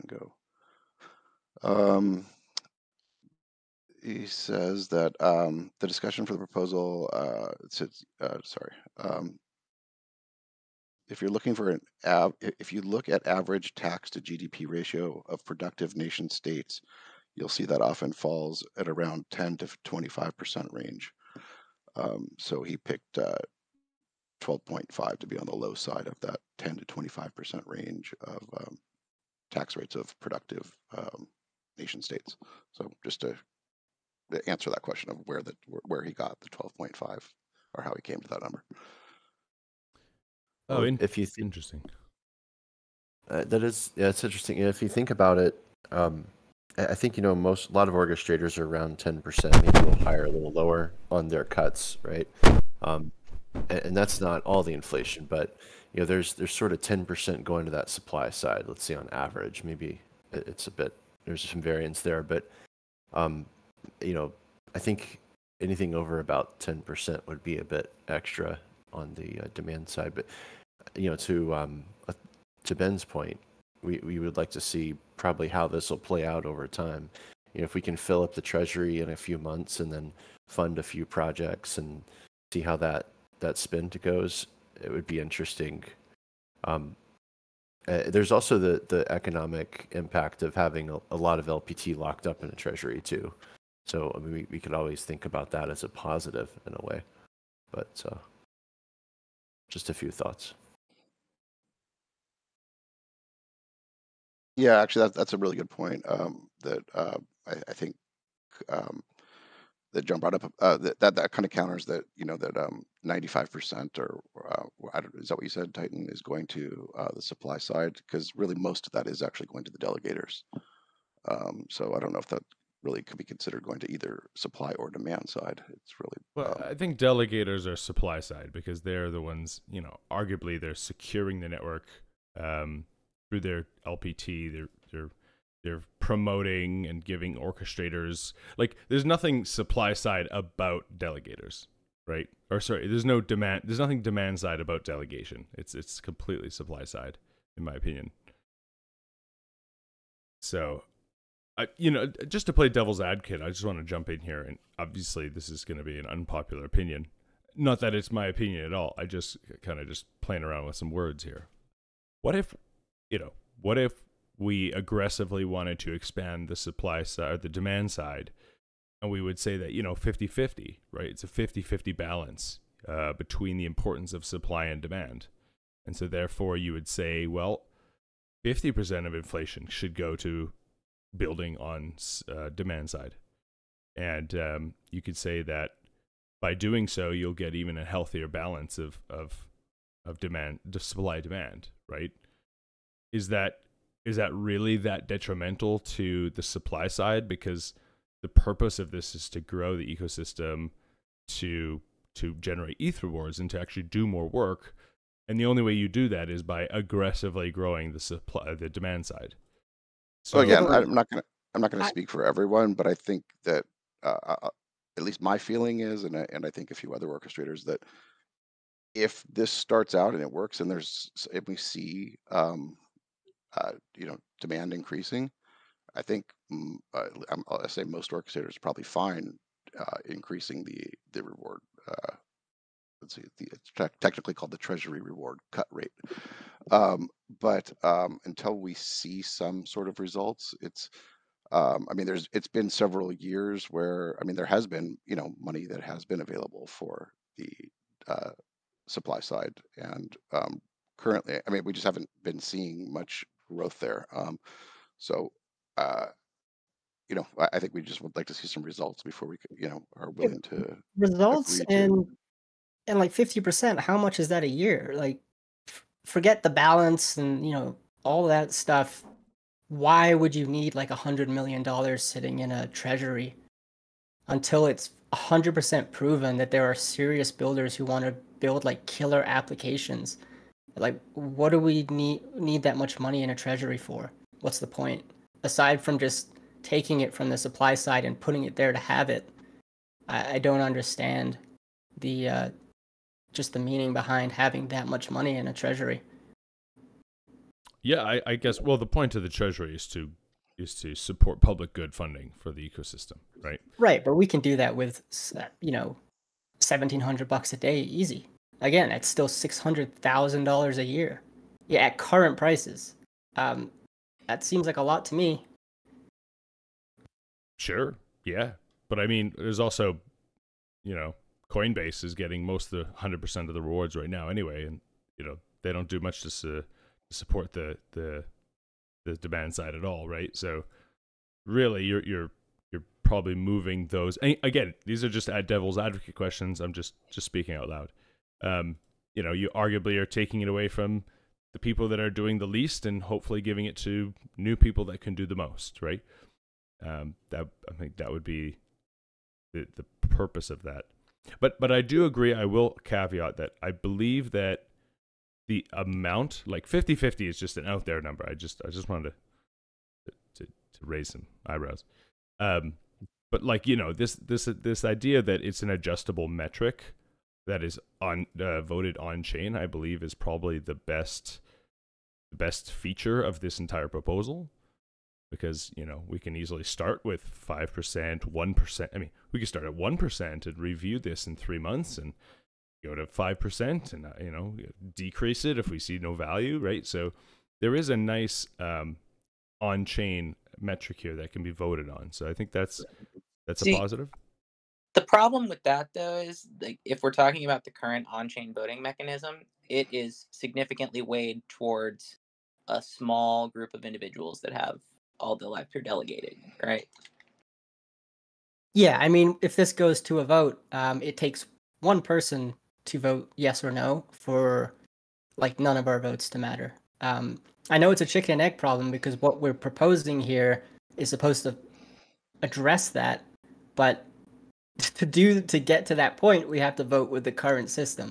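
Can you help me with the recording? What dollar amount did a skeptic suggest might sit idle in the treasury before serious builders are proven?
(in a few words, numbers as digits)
100 million dollars.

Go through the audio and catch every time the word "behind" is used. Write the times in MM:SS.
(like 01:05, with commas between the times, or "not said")
04:53.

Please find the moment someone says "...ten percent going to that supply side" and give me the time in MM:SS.
00:56.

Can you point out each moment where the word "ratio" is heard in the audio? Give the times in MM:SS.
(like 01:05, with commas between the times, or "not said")
00:14.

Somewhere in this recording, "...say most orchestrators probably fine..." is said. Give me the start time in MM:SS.
03:47.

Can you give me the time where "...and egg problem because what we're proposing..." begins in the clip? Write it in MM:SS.
06:58.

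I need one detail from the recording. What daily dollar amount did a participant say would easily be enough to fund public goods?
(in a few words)
1,700 dollars.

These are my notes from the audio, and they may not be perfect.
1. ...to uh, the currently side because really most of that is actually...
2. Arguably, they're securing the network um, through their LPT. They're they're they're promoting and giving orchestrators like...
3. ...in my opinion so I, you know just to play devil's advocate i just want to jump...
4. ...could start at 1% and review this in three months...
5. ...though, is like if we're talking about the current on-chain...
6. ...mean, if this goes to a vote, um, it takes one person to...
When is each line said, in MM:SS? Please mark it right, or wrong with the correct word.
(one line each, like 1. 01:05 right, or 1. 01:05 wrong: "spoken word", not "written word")
1. 01:56 wrong: "supply", not "currently"
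2. 02:10 right
3. 02:27 right
4. 06:19 right
5. 06:35 right
6. 06:49 right.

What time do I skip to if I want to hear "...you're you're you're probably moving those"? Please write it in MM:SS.
05:31.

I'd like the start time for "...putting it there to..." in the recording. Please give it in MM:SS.
04:48.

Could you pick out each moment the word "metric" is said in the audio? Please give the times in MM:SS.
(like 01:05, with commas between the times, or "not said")
06:06, 06:30.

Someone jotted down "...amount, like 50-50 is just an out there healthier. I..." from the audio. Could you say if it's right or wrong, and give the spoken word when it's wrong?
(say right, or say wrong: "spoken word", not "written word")
wrong: "number", not "healthier".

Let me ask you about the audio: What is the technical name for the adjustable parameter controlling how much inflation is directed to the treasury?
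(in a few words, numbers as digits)
treasury reward cut rate.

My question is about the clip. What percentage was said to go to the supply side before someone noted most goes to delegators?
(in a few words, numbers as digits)
95%.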